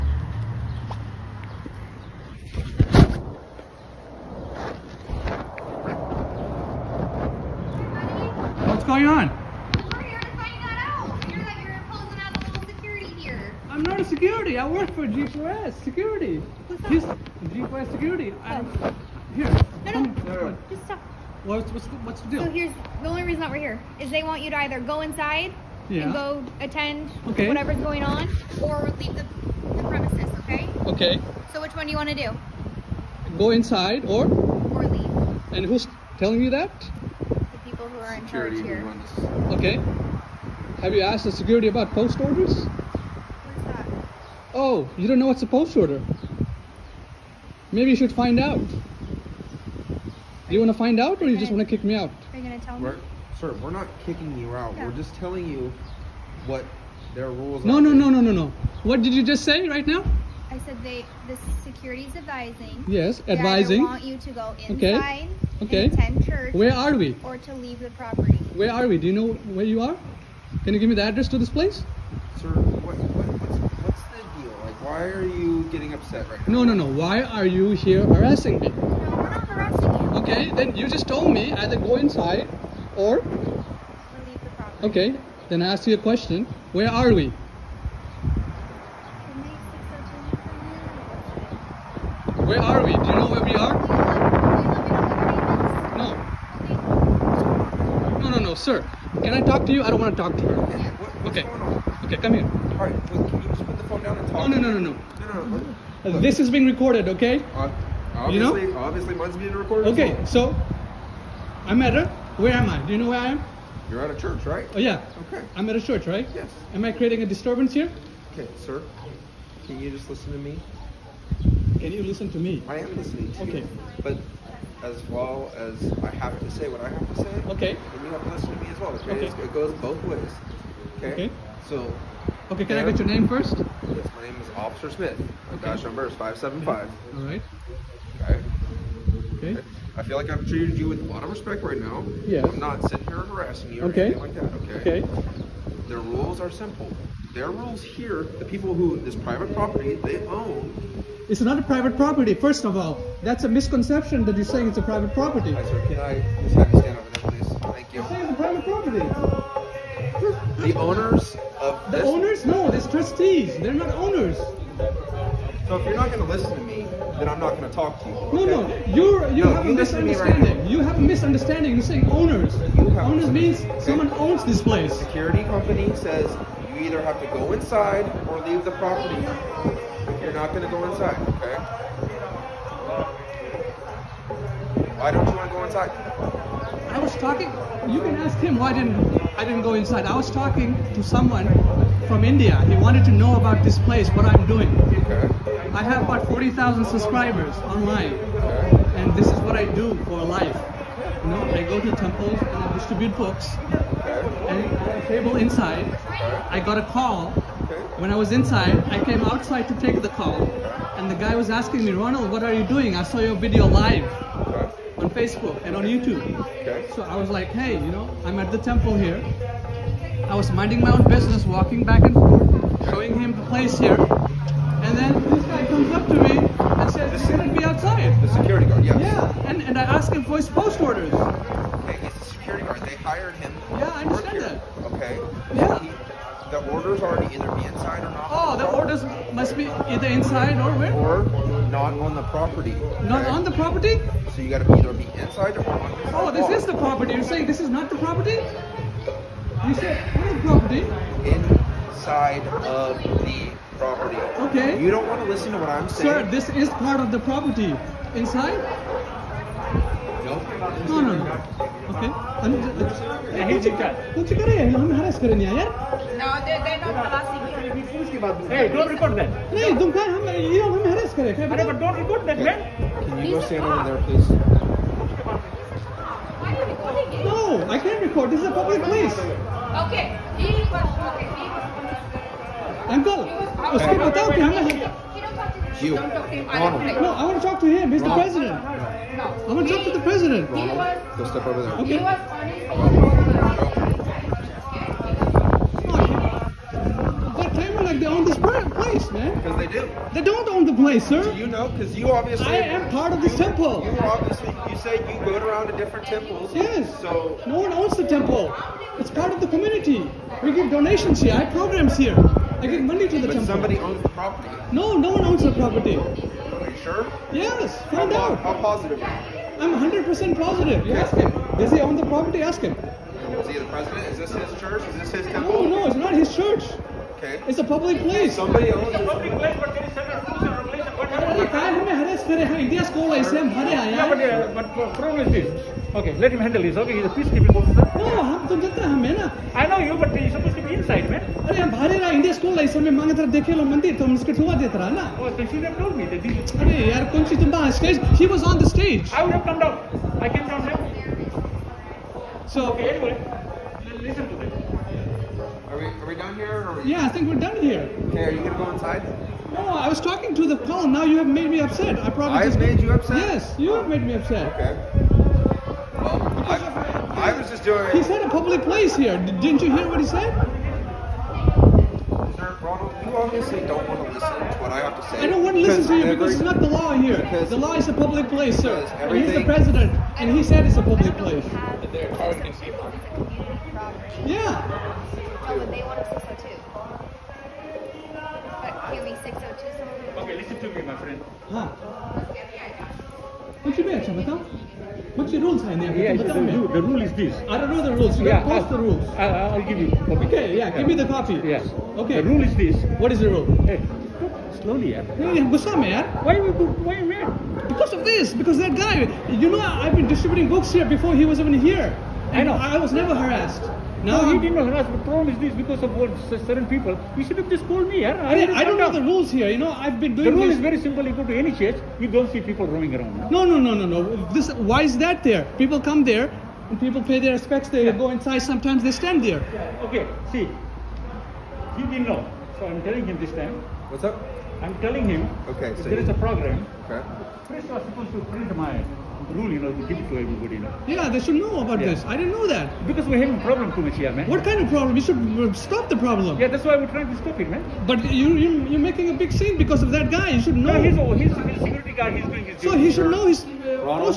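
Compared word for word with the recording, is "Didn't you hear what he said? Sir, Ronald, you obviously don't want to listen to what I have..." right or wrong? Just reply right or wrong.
right.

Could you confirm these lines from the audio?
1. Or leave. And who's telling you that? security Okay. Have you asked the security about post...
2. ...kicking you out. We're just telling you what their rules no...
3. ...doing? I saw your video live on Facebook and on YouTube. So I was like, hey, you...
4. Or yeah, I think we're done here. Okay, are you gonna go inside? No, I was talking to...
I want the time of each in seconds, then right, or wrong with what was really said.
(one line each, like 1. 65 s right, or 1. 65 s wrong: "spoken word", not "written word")
1. 34 s right
2. 54 s right
3. 212 s right
4. 356 s right.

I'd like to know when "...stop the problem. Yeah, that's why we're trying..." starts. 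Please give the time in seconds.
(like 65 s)
445 s.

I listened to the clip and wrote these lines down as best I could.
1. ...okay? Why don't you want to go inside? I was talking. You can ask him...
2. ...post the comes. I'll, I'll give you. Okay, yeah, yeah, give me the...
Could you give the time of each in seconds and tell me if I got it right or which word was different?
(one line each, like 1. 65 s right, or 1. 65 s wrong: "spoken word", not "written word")
1. 181 s right
2. 398 s wrong: "rules", not "comes".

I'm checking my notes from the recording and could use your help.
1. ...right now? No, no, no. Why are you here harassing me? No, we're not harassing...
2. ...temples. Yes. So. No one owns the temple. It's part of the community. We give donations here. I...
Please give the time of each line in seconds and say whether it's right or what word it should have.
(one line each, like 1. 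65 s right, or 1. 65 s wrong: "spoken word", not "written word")
1. 76 s right
2. 306 s right.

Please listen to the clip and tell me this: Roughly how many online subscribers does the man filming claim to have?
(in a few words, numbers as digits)
40,000.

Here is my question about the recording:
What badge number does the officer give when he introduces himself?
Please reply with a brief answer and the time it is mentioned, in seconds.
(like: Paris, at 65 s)
575, at 136 s.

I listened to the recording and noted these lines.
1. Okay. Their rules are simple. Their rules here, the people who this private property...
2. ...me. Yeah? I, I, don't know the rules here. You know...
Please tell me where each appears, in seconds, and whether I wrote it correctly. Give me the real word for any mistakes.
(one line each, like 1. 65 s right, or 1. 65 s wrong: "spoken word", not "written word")
1. 145 s right
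2. 417 s right.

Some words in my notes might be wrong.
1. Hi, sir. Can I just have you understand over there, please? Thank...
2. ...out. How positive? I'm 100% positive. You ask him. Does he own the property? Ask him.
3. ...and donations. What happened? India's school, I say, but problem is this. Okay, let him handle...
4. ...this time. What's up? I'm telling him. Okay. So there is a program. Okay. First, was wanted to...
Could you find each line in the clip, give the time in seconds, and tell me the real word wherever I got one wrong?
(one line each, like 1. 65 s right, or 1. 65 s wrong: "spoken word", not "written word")
1. 155 s wrong: "stand", not "understand"
2. 318 s right
3. 330 s wrong: "regulations", not "donations"
4. 433 s wrong: "supposed", not "wanted".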